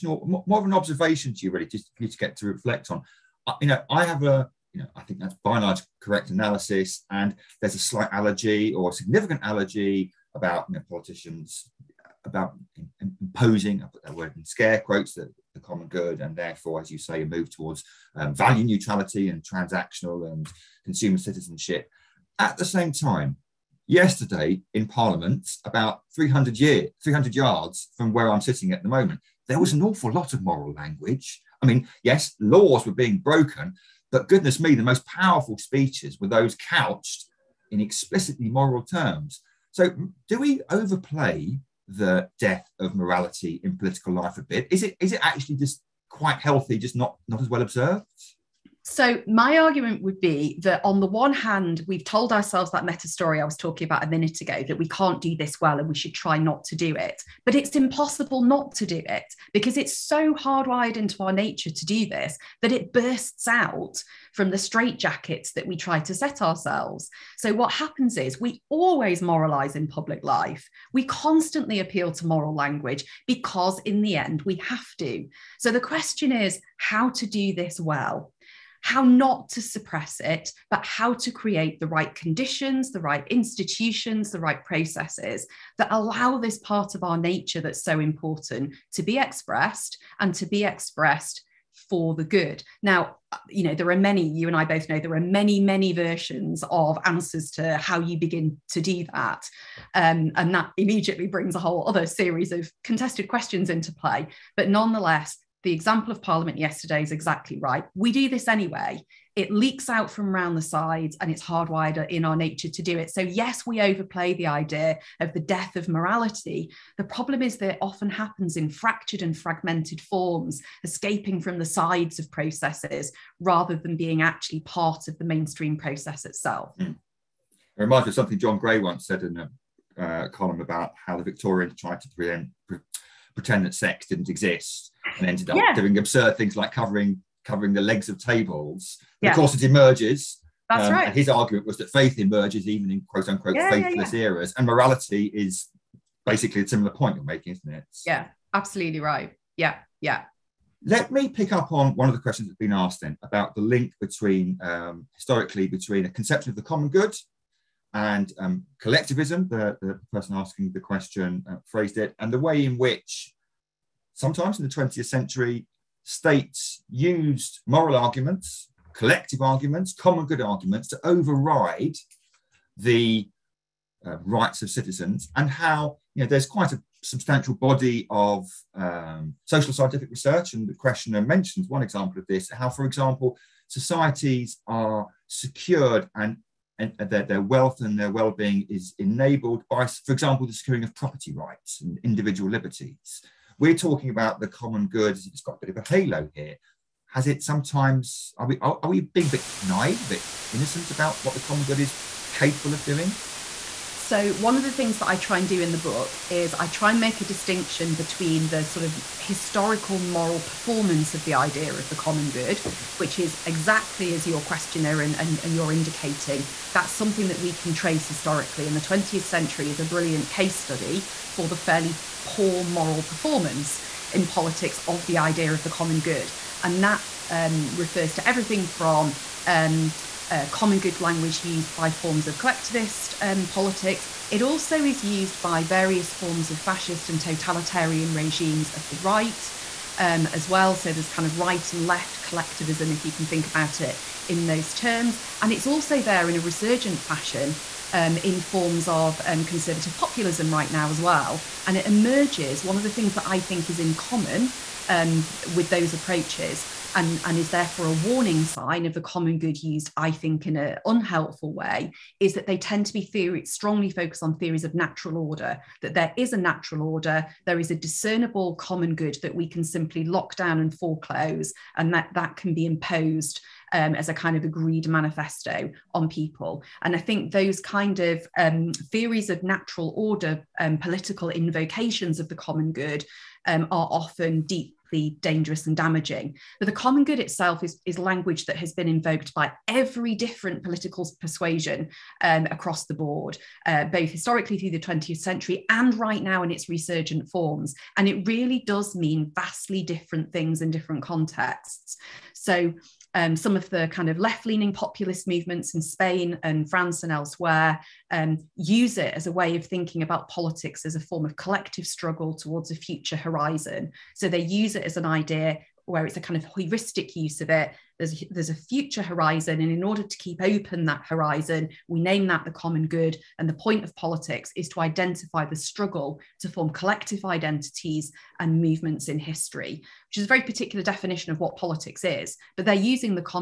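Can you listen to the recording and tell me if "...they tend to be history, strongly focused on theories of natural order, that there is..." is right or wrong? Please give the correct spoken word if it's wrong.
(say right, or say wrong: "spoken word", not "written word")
wrong: "theory", not "history".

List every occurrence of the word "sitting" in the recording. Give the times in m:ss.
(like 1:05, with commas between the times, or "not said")
0:28.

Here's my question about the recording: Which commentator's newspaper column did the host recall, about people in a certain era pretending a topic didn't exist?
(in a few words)
John Gray.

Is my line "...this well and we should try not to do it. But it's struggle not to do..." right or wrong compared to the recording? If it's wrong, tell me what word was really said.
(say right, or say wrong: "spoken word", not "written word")
wrong: "impossible", not "struggle".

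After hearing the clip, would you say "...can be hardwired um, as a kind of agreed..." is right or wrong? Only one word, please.
wrong.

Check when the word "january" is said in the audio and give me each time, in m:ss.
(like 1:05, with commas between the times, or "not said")
not said.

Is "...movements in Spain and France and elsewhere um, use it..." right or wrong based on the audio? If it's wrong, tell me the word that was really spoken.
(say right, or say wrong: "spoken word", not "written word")
right.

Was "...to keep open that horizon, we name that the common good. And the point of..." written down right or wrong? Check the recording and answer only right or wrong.
right.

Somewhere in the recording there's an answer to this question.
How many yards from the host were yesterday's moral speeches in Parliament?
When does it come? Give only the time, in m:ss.
0:27.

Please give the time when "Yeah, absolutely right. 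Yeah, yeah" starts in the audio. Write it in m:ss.
2:28.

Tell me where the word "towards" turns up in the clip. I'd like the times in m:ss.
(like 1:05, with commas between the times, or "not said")
0:17, 5:12.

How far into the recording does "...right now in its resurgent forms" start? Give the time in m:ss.
4:55.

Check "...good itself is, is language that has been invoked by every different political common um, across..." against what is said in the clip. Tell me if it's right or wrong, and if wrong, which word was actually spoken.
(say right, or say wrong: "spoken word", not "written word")
wrong: "persuasion", not "common".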